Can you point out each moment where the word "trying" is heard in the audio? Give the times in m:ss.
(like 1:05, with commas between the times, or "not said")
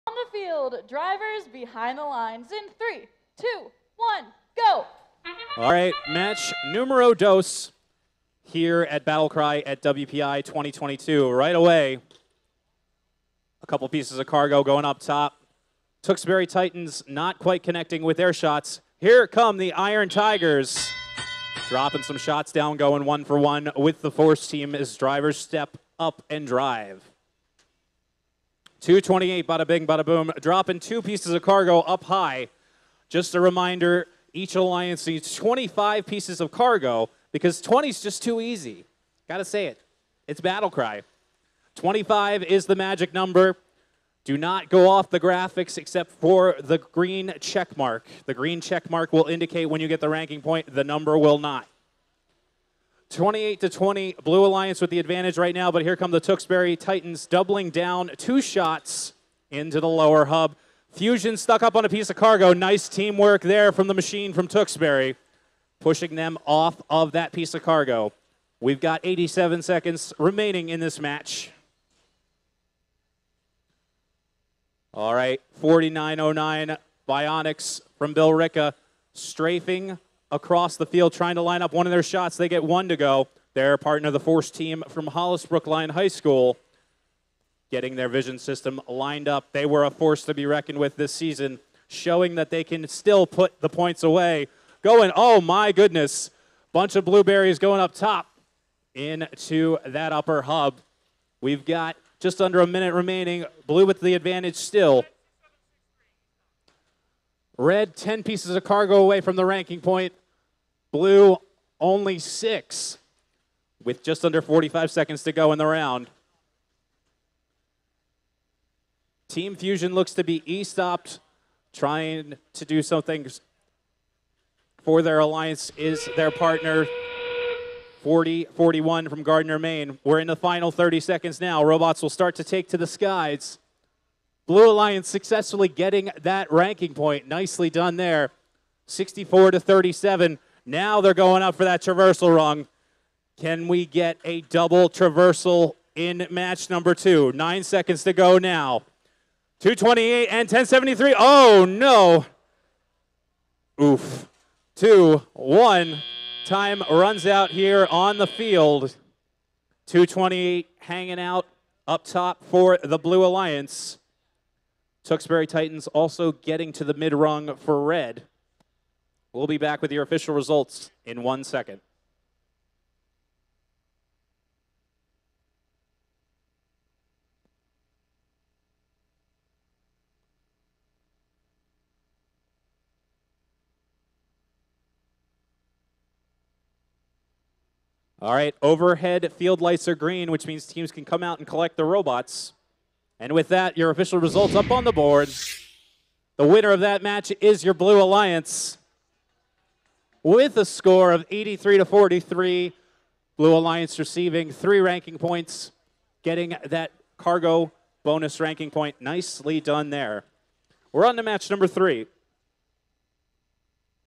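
1:21, 2:01.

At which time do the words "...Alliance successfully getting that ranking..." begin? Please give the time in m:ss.
2:14.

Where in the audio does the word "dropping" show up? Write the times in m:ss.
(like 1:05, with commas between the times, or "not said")
0:21, 0:30.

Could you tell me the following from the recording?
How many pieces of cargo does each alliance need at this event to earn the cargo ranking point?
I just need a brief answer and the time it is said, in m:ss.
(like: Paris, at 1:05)
25, at 0:41.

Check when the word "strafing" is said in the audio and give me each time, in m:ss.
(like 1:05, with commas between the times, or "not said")
1:19.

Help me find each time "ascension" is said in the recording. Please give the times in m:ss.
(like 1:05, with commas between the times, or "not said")
not said.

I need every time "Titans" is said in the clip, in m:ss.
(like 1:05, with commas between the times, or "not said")
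0:16, 0:56, 2:45.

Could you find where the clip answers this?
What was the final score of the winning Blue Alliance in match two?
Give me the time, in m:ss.
3:21.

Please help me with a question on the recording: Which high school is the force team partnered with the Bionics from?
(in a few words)
Hollis Brookline High School.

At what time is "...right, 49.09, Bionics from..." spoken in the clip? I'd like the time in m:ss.
1:15.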